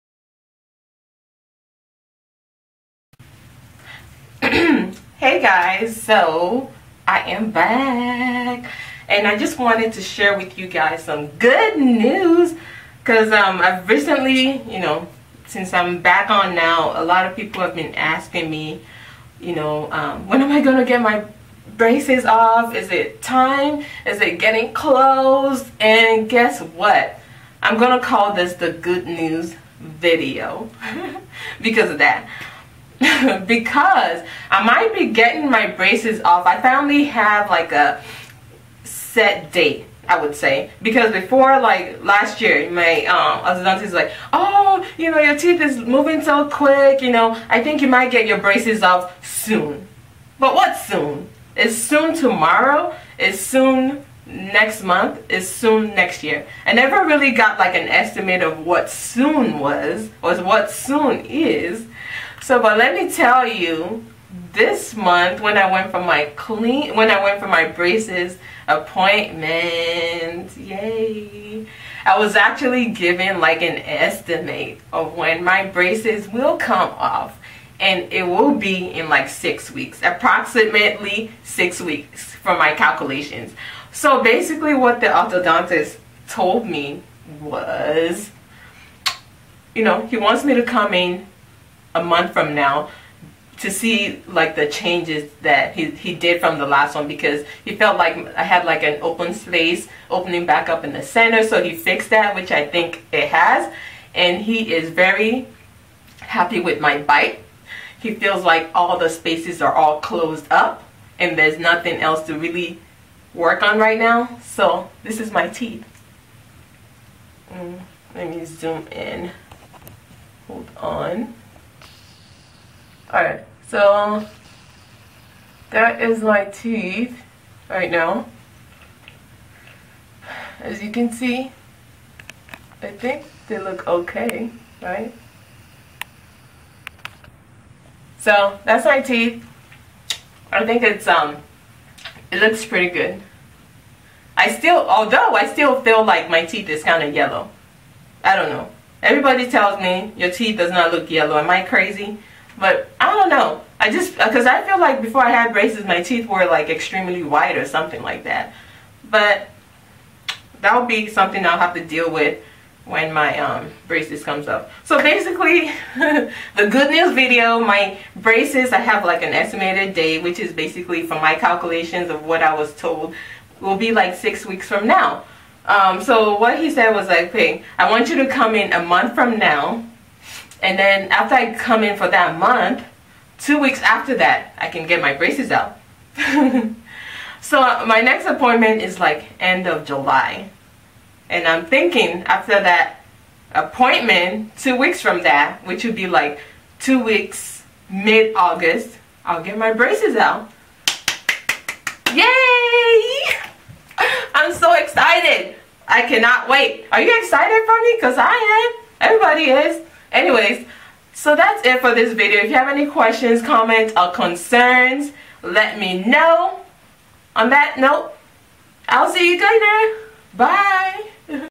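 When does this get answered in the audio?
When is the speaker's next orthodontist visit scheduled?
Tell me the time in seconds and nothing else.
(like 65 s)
189 s.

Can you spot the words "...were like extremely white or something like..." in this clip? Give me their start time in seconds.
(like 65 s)
156 s.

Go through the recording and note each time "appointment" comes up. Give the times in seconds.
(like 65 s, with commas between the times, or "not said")
68 s, 188 s, 193 s.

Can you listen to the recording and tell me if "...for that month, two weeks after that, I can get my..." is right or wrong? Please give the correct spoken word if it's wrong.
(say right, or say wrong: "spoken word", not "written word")
right.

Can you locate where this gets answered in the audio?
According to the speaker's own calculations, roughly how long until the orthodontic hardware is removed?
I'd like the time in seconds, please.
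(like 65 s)
80 s.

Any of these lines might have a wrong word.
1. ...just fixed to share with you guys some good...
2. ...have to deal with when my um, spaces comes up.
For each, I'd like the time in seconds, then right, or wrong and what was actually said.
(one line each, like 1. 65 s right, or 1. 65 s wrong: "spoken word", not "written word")
1. 9 s wrong: "wanted", not "fixed"
2. 161 s wrong: "braces", not "spaces".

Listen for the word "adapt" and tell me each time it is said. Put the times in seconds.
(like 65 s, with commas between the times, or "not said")
not said.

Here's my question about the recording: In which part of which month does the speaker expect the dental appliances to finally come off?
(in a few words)
mid-August.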